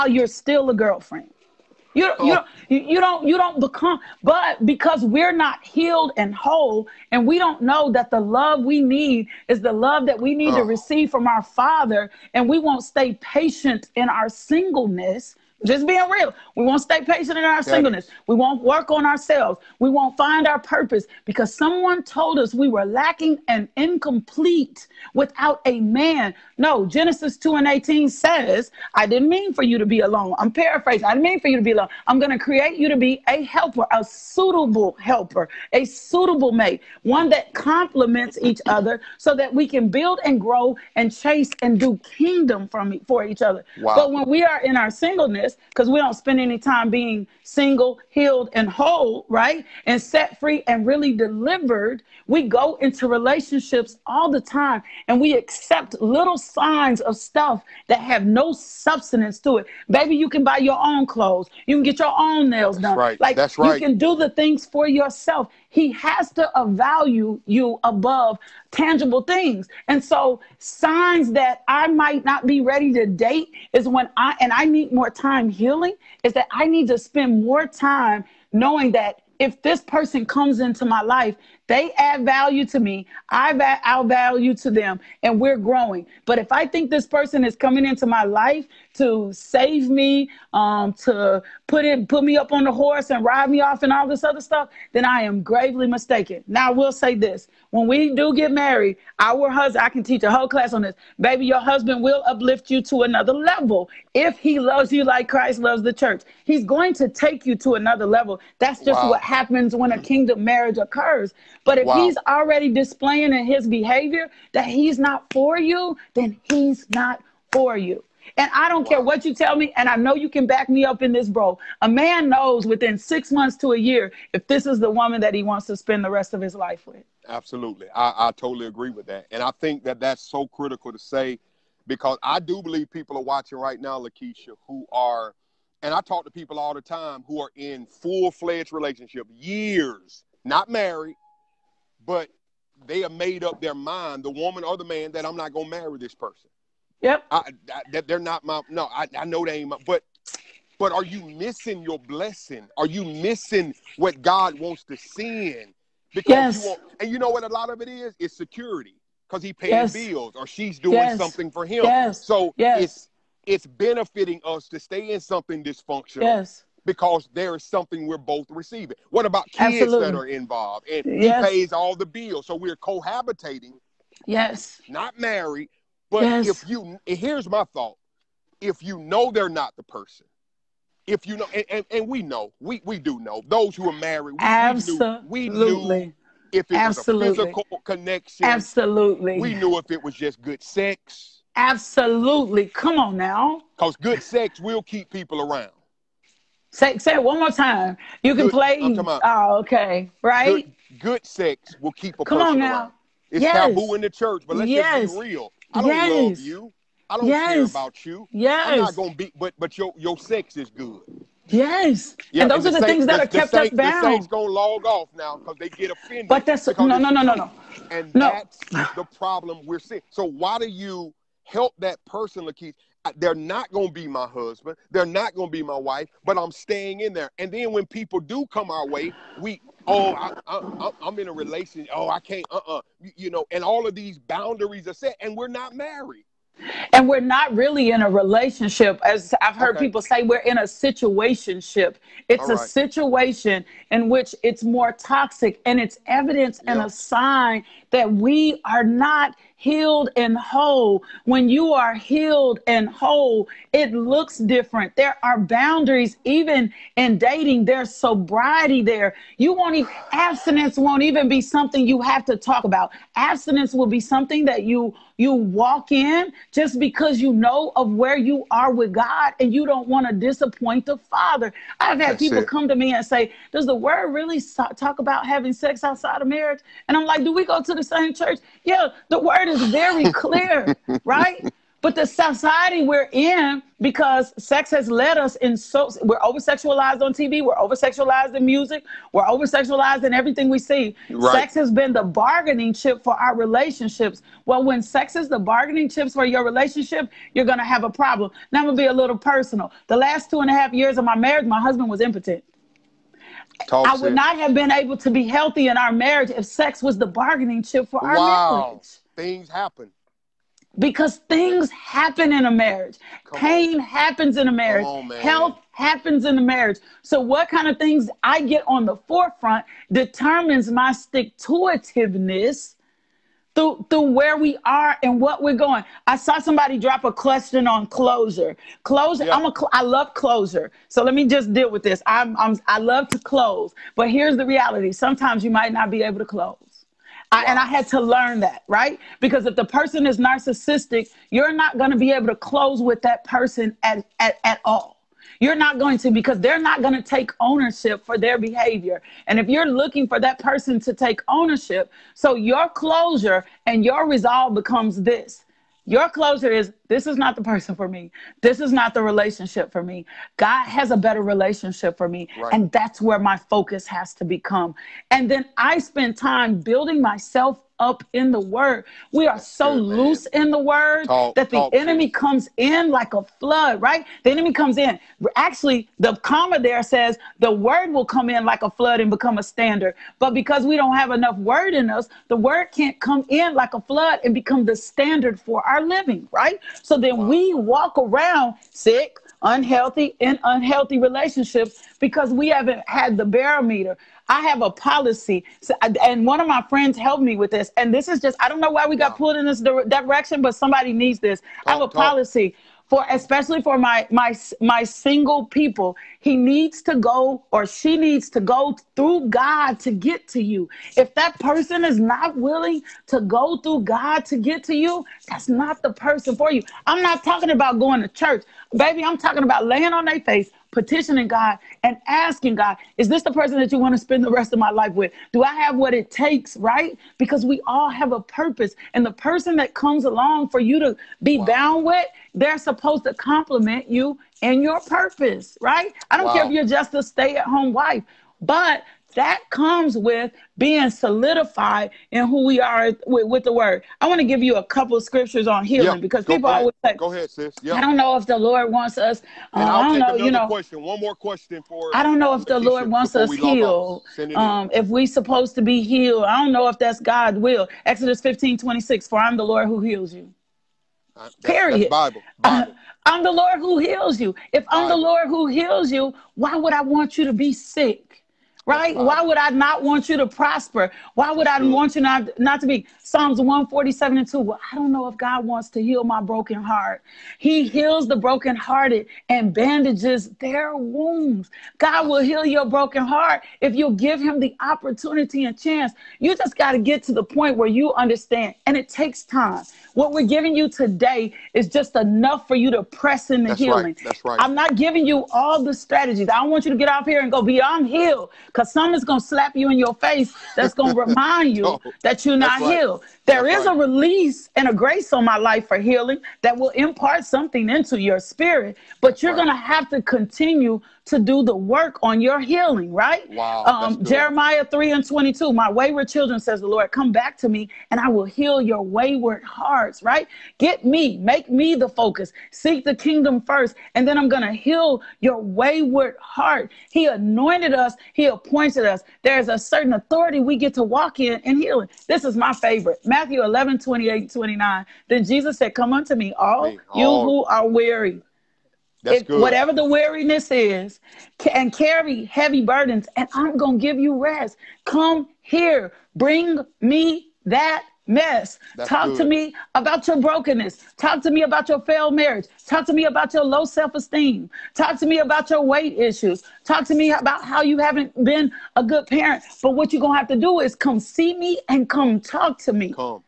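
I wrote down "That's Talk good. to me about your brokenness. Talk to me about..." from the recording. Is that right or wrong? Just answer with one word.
right.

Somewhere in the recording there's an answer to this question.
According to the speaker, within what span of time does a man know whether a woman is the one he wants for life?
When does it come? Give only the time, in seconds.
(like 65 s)
122 s.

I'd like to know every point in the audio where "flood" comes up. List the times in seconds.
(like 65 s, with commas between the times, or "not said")
373 s, 378 s, 383 s.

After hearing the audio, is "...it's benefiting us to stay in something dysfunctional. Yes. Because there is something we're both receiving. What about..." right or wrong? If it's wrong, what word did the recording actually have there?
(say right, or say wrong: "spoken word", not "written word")
right.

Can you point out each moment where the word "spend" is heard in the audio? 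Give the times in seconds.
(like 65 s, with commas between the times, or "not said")
46 s, 76 s, 125 s, 365 s, 423 s.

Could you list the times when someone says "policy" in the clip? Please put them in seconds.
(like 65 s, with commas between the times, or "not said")
394 s, 401 s.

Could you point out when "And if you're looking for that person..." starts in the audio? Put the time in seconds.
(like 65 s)
349 s.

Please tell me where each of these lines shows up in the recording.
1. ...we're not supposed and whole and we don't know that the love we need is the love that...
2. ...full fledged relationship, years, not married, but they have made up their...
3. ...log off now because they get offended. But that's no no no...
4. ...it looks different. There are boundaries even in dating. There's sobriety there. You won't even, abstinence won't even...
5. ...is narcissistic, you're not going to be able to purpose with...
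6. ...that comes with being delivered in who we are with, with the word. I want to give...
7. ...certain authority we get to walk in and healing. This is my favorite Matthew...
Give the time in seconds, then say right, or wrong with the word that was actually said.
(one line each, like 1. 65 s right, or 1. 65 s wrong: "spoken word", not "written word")
1. 5 s wrong: "healed", not "supposed"
2. 137 s right
3. 214 s right
4. 253 s right
5. 340 s wrong: "close", not "purpose"
6. 439 s wrong: "solidified", not "delivered"
7. 529 s right.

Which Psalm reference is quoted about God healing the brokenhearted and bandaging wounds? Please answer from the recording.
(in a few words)
Psalms 147:2.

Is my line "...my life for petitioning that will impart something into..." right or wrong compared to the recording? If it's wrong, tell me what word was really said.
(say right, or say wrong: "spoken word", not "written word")
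wrong: "healing", not "petitioning".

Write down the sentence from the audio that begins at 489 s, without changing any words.
What we're giving you today is just enough for you to press in the That's healing.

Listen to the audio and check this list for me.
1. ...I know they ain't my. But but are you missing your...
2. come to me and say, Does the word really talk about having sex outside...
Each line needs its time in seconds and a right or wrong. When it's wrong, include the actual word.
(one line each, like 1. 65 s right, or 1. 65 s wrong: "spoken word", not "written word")
1. 149 s right
2. 272 s right.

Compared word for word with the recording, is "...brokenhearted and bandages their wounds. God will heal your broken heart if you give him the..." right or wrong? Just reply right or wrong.
right.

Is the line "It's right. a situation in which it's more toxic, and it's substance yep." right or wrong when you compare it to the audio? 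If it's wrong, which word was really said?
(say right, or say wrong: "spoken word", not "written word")
wrong: "evidence", not "substance".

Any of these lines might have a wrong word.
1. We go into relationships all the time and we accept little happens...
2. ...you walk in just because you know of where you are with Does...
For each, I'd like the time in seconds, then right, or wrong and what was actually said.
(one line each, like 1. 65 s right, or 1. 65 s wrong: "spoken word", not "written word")
1. 52 s wrong: "signs", not "happens"
2. 265 s wrong: "God", not "Does".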